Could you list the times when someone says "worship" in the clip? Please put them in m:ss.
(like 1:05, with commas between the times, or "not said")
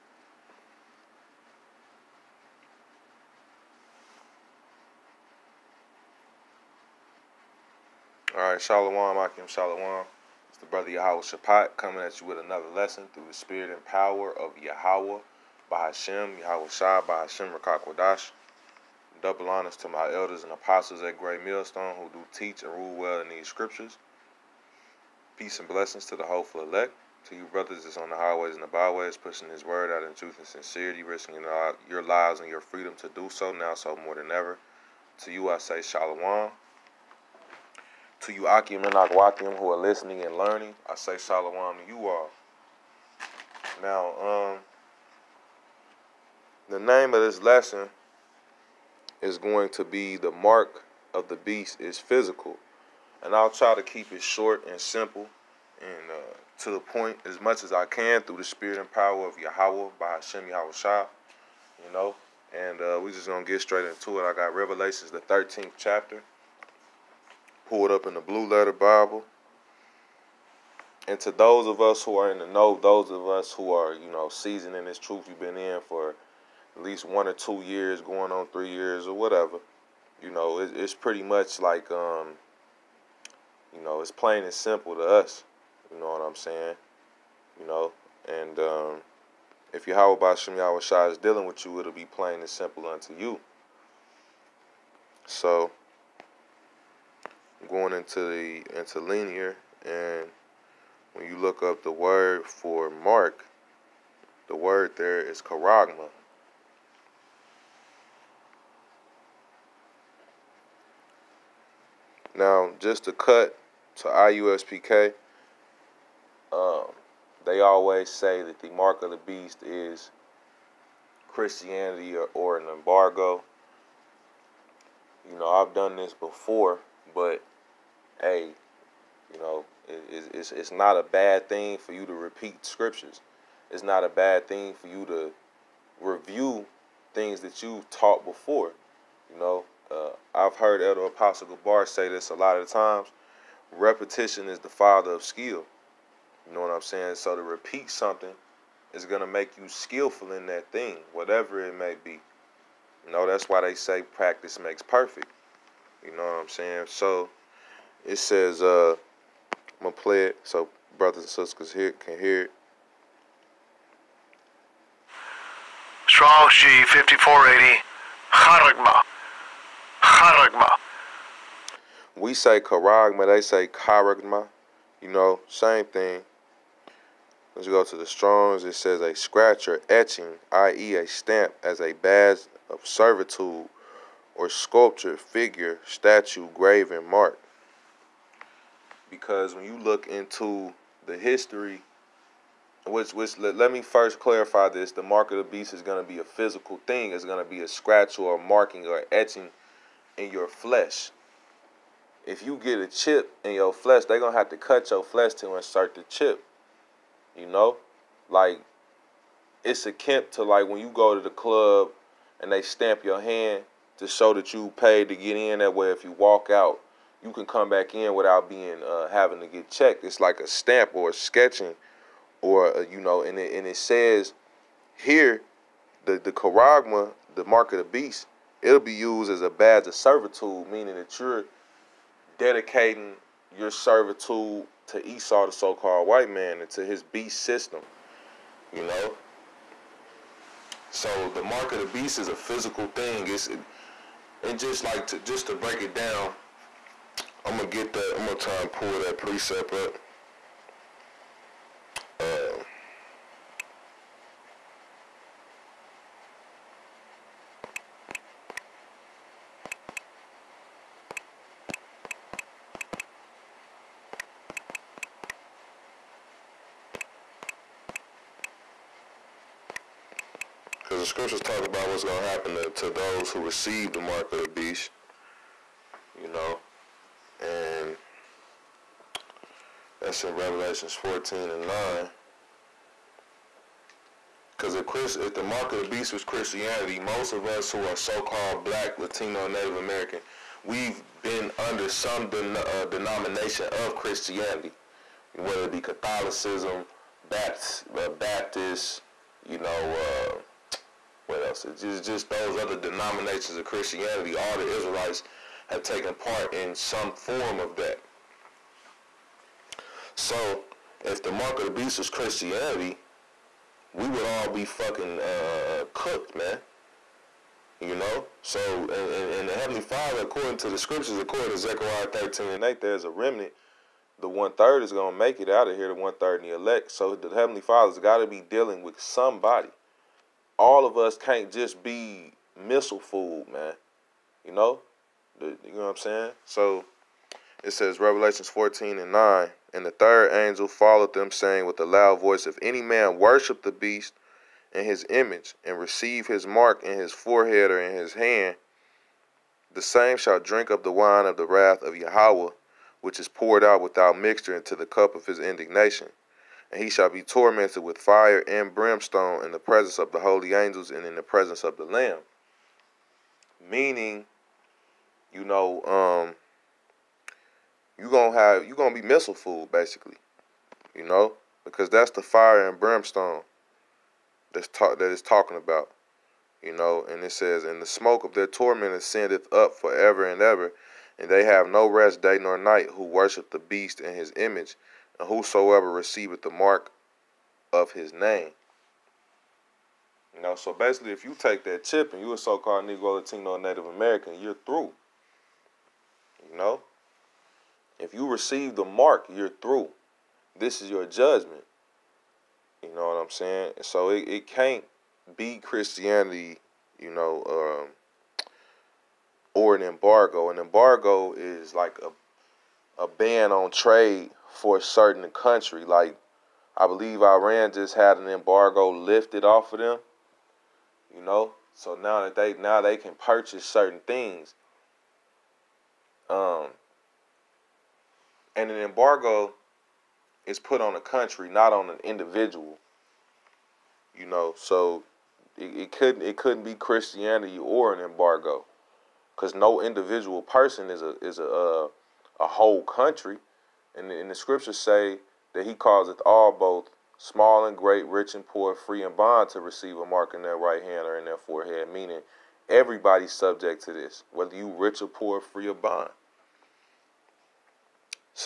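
5:43, 6:23.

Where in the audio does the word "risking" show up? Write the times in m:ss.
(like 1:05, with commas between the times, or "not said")
0:31.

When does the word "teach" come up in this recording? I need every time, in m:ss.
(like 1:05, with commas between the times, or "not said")
0:22.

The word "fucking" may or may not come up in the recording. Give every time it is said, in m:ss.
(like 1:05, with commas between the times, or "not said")
5:14.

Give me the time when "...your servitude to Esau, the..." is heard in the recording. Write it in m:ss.
3:53.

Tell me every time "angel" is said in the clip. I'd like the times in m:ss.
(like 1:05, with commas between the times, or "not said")
5:40, 6:00.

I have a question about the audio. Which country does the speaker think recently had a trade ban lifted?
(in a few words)
Iran.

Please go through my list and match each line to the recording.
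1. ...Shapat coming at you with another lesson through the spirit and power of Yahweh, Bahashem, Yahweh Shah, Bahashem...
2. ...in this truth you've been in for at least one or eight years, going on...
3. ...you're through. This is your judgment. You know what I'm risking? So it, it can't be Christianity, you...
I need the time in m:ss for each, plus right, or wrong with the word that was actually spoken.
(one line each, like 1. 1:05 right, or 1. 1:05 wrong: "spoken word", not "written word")
1. 0:11 right
2. 1:14 wrong: "two", not "eight"
3. 6:39 wrong: "saying", not "risking".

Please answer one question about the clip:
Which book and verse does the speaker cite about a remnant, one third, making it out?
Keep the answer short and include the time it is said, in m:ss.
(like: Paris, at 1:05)
Zechariah 13:8, at 5:21.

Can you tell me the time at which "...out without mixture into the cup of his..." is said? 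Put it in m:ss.
5:53.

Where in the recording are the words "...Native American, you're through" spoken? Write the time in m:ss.
6:33.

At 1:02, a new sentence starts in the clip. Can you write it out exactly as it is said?
And uh, we're just going to get straight into it.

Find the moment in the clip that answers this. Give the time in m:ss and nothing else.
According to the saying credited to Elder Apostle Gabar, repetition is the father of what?
2:25.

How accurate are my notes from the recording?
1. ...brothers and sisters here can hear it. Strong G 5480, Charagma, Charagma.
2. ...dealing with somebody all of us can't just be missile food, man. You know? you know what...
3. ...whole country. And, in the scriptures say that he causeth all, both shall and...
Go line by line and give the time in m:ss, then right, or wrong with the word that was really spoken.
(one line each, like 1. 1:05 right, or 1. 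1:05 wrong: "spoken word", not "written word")
1. 2:40 right
2. 5:28 right
3. 7:22 wrong: "small", not "shall".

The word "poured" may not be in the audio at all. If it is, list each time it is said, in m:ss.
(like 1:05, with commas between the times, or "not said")
5:53.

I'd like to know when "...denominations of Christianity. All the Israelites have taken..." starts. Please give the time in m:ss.
5:02.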